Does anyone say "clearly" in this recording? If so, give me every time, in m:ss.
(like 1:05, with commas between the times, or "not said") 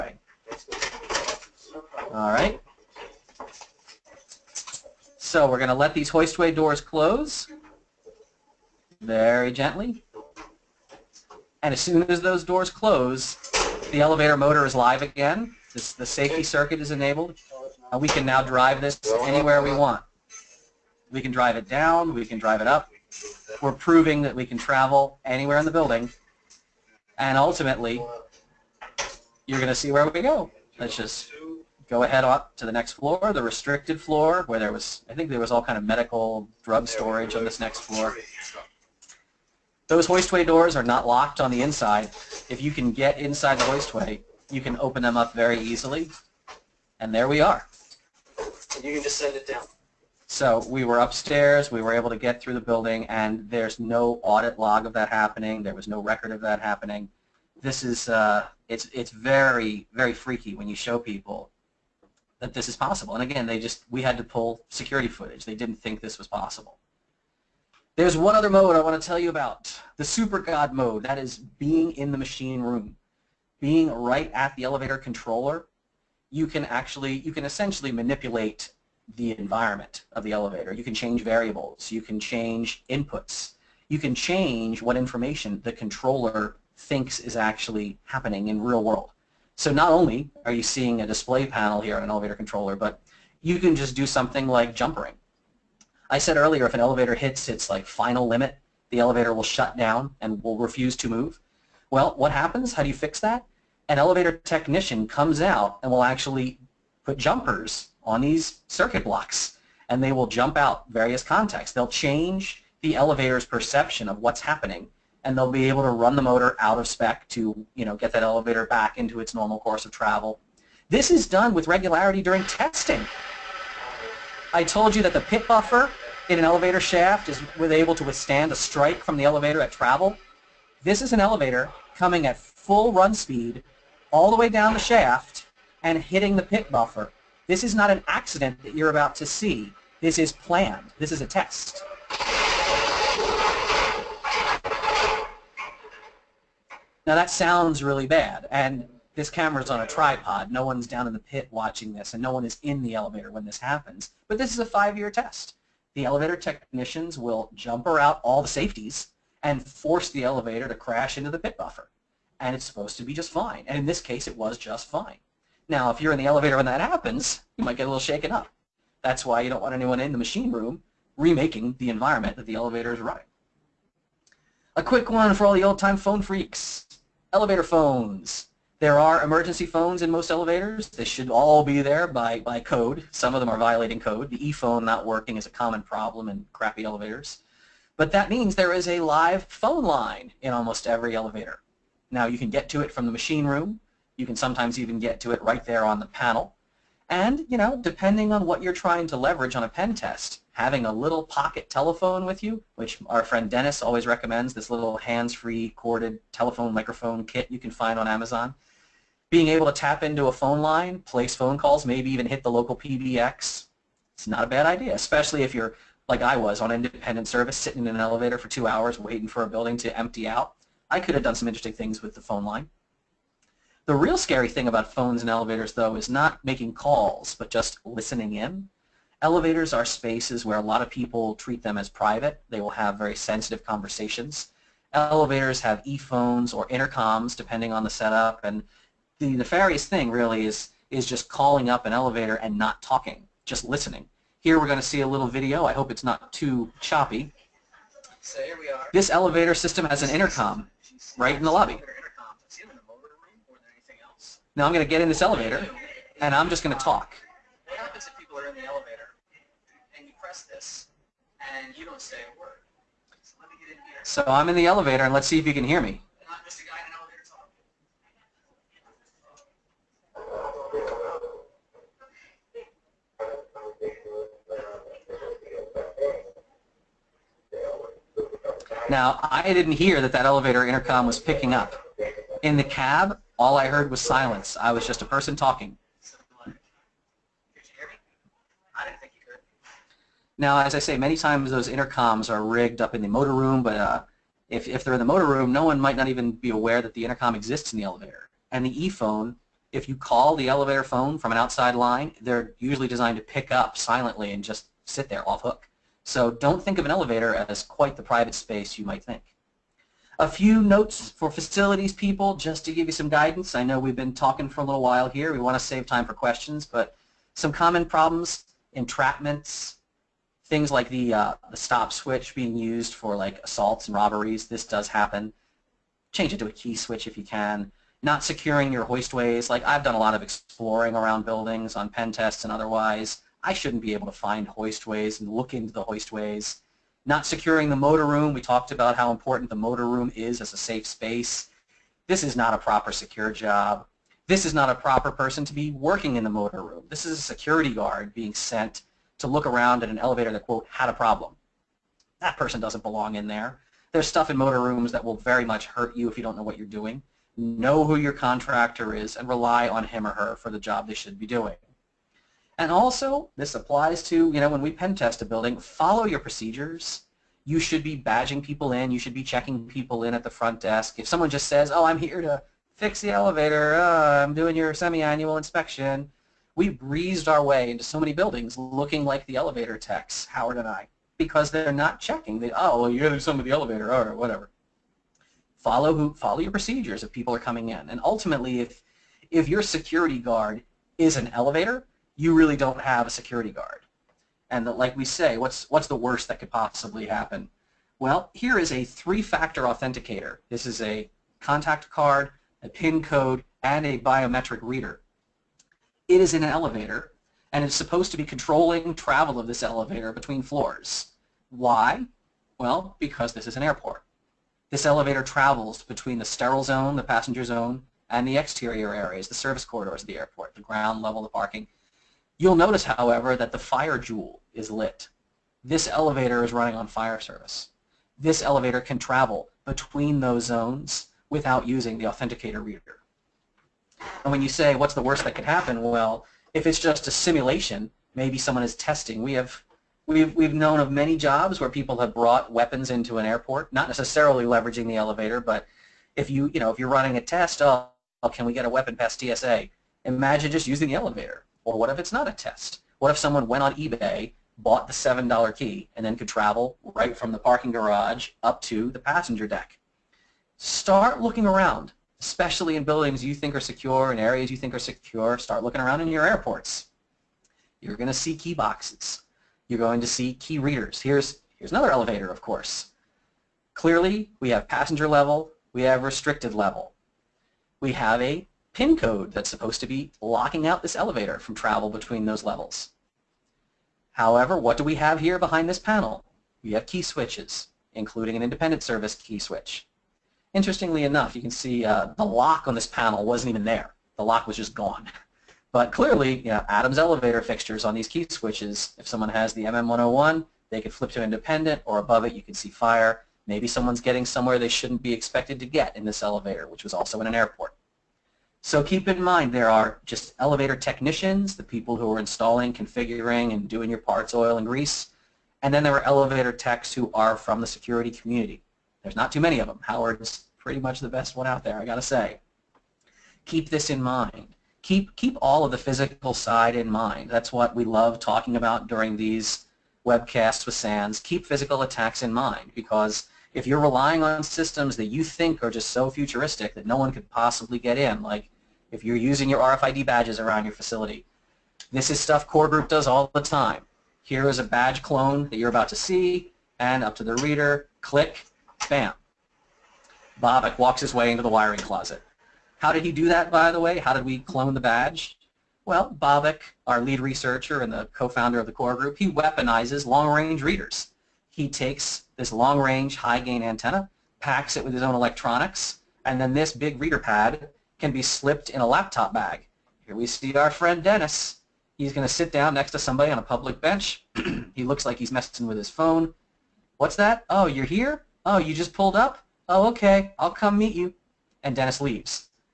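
7:53, 8:15.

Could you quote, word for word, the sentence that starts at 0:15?
This, the safety circuit is enabled.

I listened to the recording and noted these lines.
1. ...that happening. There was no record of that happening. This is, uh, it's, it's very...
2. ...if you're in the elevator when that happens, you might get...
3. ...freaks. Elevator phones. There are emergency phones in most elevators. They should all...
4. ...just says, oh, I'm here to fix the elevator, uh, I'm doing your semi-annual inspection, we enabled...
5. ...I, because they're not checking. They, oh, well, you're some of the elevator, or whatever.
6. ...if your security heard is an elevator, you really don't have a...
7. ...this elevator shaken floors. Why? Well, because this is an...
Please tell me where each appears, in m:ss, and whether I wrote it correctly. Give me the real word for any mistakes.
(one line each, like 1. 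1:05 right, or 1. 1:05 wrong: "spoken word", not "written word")
1. 0:54 right
2. 2:45 right
3. 2:56 right
4. 6:11 wrong: "breezed", not "enabled"
5. 6:20 right
6. 6:29 wrong: "guard", not "heard"
7. 6:49 wrong: "between", not "shaken".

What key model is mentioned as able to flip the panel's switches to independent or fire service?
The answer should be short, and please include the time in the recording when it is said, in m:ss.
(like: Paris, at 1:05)
MM101, at 8:19.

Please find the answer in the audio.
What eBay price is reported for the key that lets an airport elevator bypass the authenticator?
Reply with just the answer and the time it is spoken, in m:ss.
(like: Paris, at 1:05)
$7, at 7:34.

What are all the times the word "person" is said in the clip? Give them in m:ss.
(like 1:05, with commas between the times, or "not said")
4:45, 5:45, 5:52.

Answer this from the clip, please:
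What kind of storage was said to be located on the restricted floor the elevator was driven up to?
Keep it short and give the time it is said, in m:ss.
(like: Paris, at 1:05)
Medical drug storage, at 0:35.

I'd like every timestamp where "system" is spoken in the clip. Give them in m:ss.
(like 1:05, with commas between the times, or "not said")
4:09, 8:54.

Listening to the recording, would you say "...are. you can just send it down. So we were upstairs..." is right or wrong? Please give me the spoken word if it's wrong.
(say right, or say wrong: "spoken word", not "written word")
right.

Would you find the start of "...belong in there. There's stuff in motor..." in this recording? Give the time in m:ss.
5:52.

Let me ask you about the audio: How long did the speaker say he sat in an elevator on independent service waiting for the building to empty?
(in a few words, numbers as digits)
2 hours.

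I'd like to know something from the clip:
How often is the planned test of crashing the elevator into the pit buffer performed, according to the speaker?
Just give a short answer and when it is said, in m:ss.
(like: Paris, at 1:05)
Five-year test, at 2:34.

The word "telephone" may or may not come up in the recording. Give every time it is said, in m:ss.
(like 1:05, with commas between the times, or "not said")
3:21, 3:26.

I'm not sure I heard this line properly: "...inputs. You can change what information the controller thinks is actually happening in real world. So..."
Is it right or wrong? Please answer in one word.
right.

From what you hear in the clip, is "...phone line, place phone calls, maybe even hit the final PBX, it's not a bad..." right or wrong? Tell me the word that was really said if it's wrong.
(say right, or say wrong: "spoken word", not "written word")
wrong: "local", not "final".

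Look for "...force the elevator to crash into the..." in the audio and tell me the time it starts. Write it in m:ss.
2:39.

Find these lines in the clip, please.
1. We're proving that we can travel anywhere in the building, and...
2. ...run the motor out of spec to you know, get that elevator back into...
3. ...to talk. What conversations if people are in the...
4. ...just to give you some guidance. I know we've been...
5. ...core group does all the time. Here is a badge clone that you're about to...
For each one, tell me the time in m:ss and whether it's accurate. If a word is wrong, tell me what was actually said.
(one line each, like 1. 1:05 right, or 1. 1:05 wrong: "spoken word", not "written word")
1. 0:23 right
2. 1:55 right
3. 4:16 wrong: "happens", not "conversations"
4. 5:12 right
5. 9:02 right.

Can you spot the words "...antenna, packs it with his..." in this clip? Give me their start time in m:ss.
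9:23.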